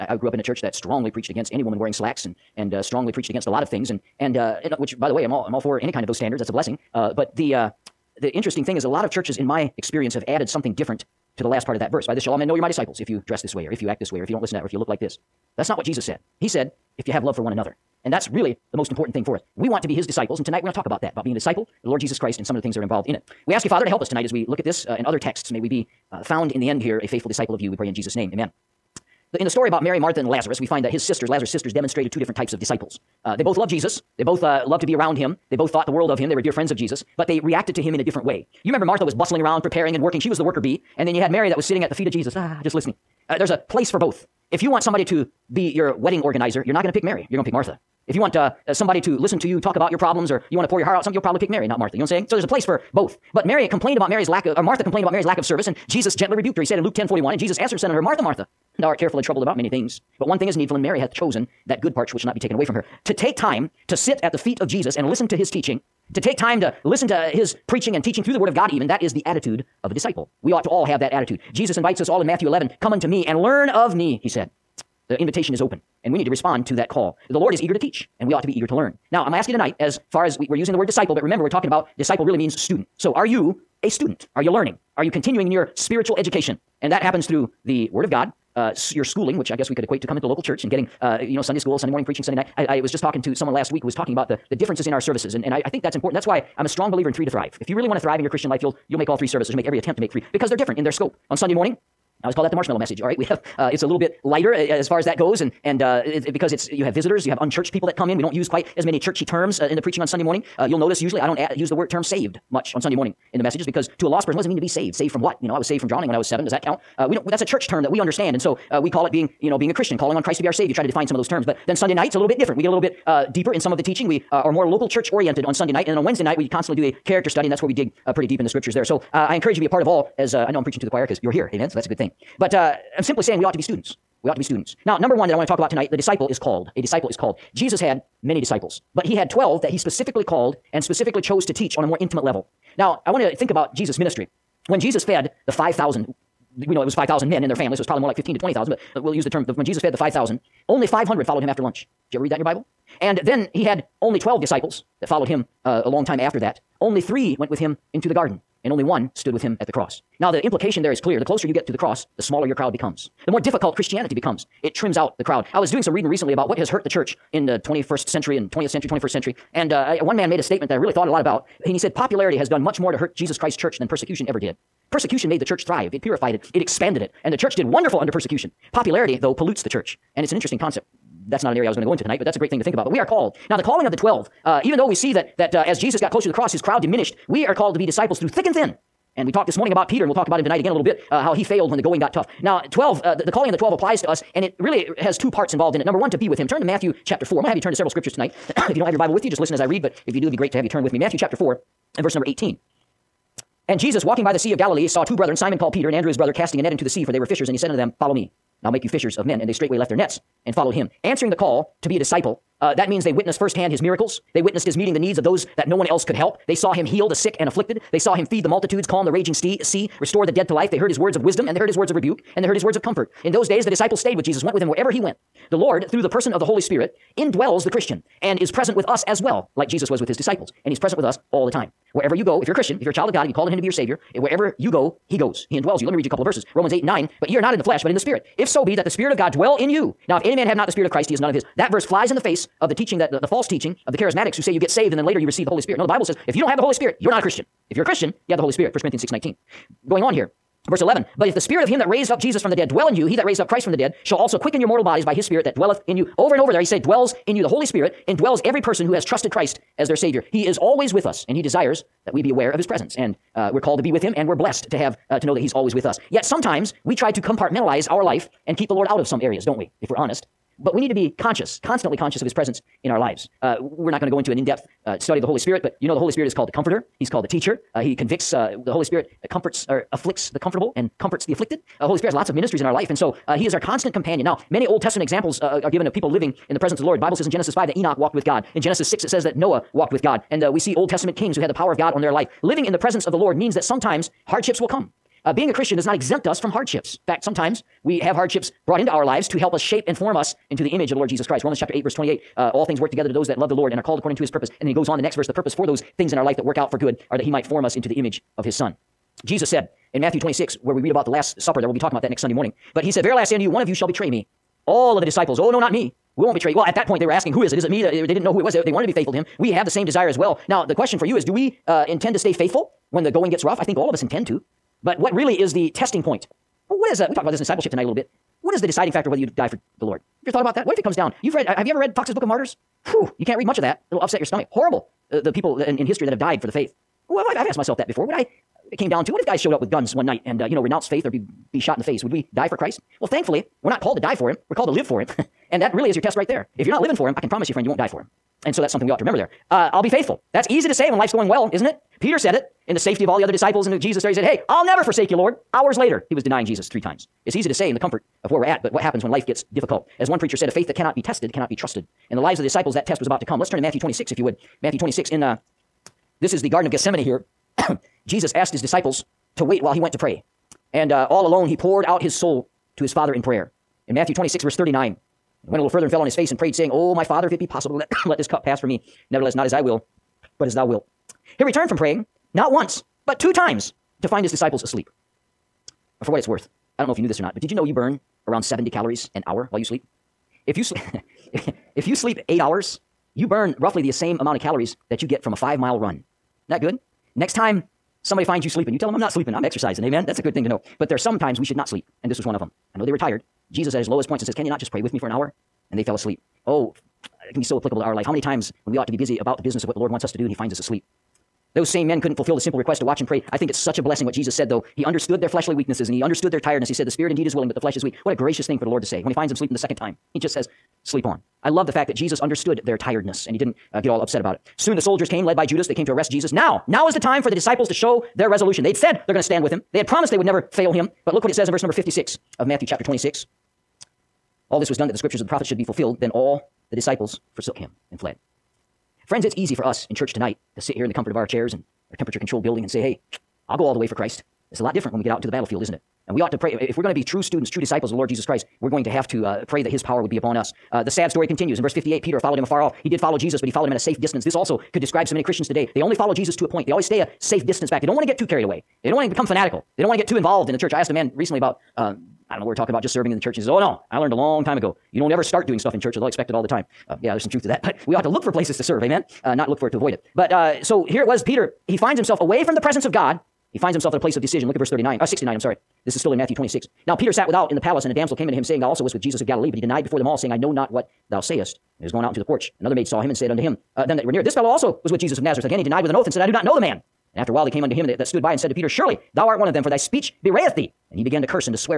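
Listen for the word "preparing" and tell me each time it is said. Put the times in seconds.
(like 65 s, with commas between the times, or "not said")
39 s.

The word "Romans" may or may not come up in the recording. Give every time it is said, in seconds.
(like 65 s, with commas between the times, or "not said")
236 s, 301 s.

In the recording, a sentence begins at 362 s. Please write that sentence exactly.
In the lives of the disciples, that test was about to come.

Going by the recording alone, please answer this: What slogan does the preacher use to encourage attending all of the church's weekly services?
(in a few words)
three to thrive.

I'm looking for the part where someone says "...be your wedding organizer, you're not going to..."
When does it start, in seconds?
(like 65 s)
45 s.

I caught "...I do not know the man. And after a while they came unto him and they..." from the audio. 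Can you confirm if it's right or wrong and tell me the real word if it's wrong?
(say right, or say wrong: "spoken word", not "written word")
right.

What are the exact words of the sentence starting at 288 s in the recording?
In Genesis 6, it says that Noah walked with God.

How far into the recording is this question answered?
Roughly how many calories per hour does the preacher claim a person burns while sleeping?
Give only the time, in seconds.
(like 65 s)
388 s.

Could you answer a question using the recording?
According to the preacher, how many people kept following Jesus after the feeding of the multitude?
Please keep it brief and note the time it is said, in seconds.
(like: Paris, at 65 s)
500, at 150 s.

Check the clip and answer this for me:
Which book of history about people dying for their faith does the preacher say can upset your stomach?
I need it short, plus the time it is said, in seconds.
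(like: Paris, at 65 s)
Fox's Book of Martyrs, at 331 s.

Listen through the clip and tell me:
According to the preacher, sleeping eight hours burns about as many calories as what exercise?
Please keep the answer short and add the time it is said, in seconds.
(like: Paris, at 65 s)
a five mile run, at 395 s.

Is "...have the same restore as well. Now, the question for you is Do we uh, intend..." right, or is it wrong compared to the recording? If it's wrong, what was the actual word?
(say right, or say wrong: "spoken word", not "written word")
wrong: "desire", not "restore".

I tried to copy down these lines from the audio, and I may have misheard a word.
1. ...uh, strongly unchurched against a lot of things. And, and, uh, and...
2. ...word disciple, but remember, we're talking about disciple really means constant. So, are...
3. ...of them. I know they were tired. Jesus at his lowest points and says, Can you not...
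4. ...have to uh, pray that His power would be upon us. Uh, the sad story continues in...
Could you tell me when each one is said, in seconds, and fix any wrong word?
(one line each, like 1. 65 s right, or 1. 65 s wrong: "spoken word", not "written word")
1. 2 s wrong: "preached", not "unchurched"
2. 80 s wrong: "student", not "constant"
3. 402 s right
4. 448 s right.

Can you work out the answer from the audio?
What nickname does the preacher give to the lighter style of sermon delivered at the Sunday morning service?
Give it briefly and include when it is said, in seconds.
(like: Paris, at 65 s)
the marshmallow message, at 102 s.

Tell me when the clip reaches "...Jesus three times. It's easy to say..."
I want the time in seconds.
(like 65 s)
356 s.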